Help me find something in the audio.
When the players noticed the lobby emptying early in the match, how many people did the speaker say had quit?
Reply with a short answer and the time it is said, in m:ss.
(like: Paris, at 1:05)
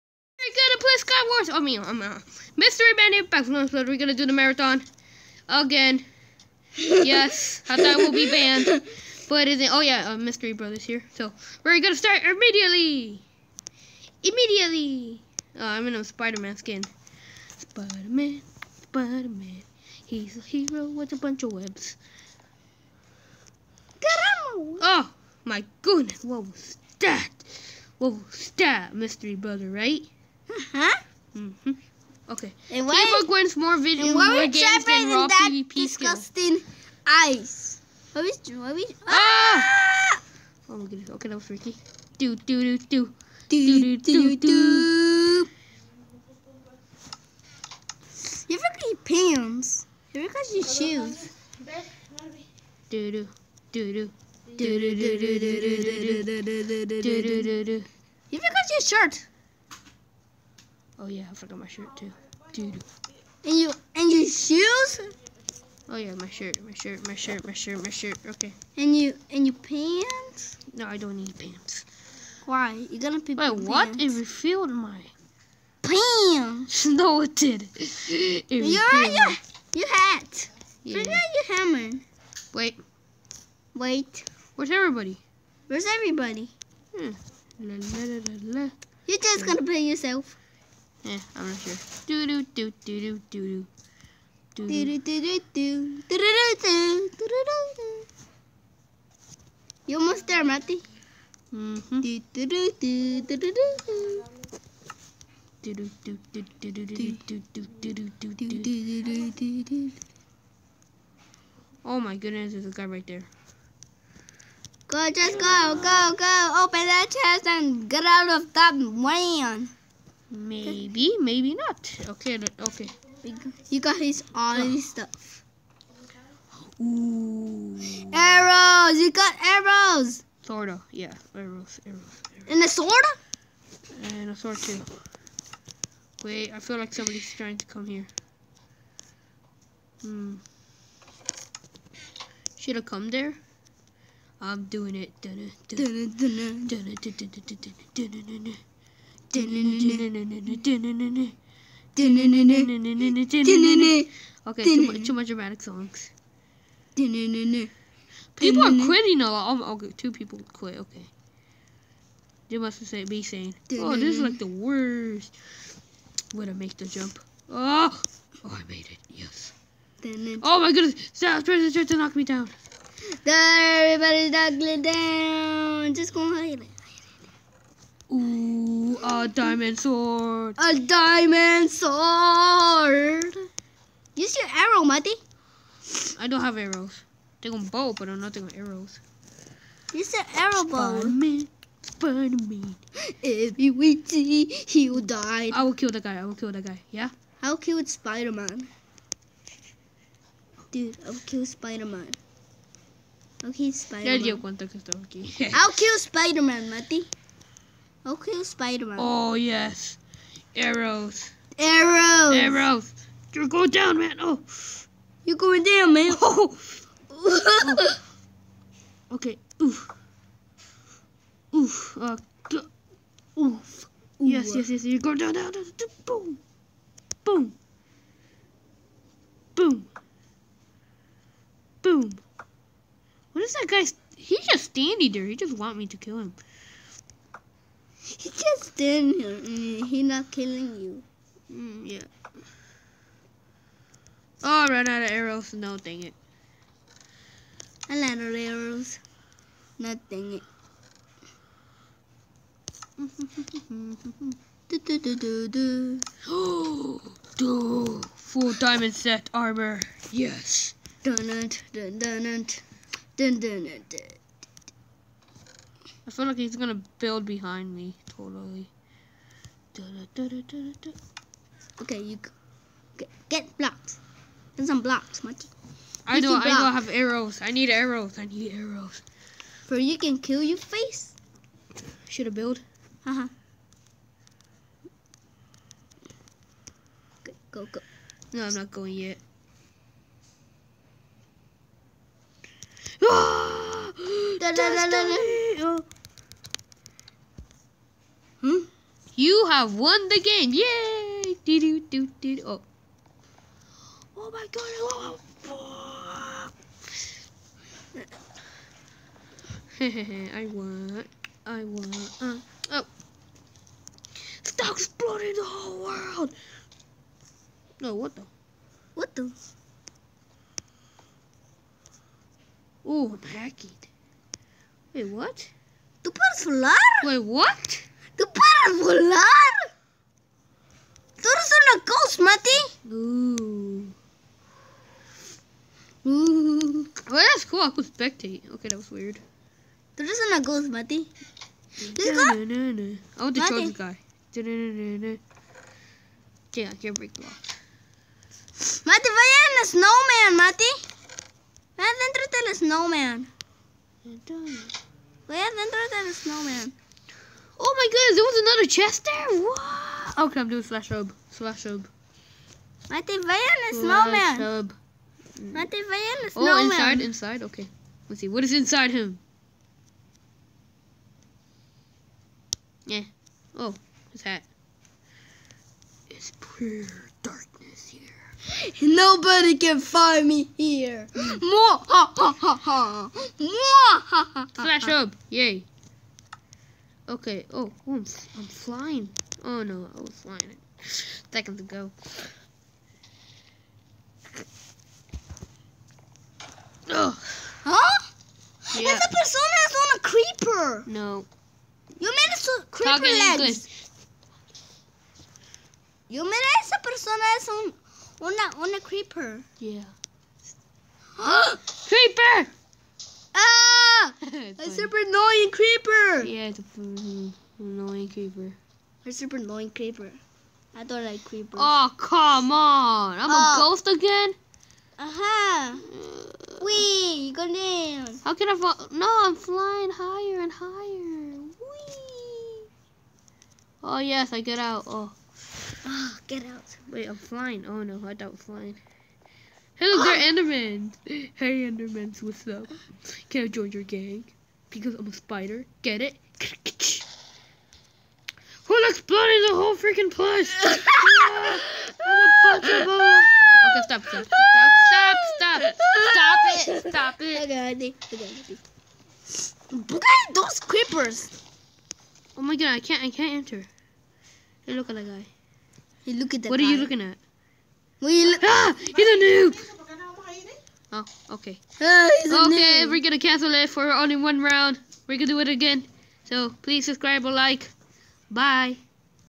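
2, at 2:39.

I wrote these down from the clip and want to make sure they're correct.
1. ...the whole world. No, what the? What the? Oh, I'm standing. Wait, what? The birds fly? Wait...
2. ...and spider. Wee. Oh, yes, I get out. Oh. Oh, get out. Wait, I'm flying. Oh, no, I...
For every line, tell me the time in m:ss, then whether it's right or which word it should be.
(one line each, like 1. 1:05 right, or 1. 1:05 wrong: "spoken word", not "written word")
1. 5:15 wrong: "hacking", not "standing"
2. 7:10 wrong: "higher", not "spider".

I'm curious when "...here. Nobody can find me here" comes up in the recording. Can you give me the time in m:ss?
6:17.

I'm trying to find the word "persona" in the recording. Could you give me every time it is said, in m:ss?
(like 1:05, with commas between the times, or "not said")
6:39, 6:46.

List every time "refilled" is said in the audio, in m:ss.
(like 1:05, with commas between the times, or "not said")
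1:14.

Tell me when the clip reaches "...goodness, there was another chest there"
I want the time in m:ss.
5:57.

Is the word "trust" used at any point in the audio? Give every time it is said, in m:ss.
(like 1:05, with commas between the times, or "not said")
not said.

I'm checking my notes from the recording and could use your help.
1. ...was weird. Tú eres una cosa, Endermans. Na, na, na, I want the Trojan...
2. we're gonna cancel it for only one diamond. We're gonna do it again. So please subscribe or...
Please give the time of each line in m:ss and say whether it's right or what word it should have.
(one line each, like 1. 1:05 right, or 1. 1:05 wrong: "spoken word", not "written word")
1. 5:38 wrong: "Mati", not "Endermans"
2. 7:52 wrong: "round", not "diamond".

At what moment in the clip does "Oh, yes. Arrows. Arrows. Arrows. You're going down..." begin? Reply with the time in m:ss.
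3:28.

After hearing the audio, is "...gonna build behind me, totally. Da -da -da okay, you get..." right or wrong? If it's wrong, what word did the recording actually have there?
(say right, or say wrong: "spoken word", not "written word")
right.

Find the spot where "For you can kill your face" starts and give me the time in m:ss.
4:39.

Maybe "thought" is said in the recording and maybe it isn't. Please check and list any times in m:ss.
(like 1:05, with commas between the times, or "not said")
0:07.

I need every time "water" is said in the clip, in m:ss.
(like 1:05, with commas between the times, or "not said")
not said.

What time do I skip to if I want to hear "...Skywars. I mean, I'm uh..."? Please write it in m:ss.
0:00.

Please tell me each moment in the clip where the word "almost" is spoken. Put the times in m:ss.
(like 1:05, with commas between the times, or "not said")
1:39.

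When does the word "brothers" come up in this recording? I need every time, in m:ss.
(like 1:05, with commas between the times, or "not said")
0:10, 0:29.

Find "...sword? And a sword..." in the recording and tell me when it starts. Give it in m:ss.
2:12.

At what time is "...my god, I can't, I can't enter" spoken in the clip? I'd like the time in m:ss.
7:42.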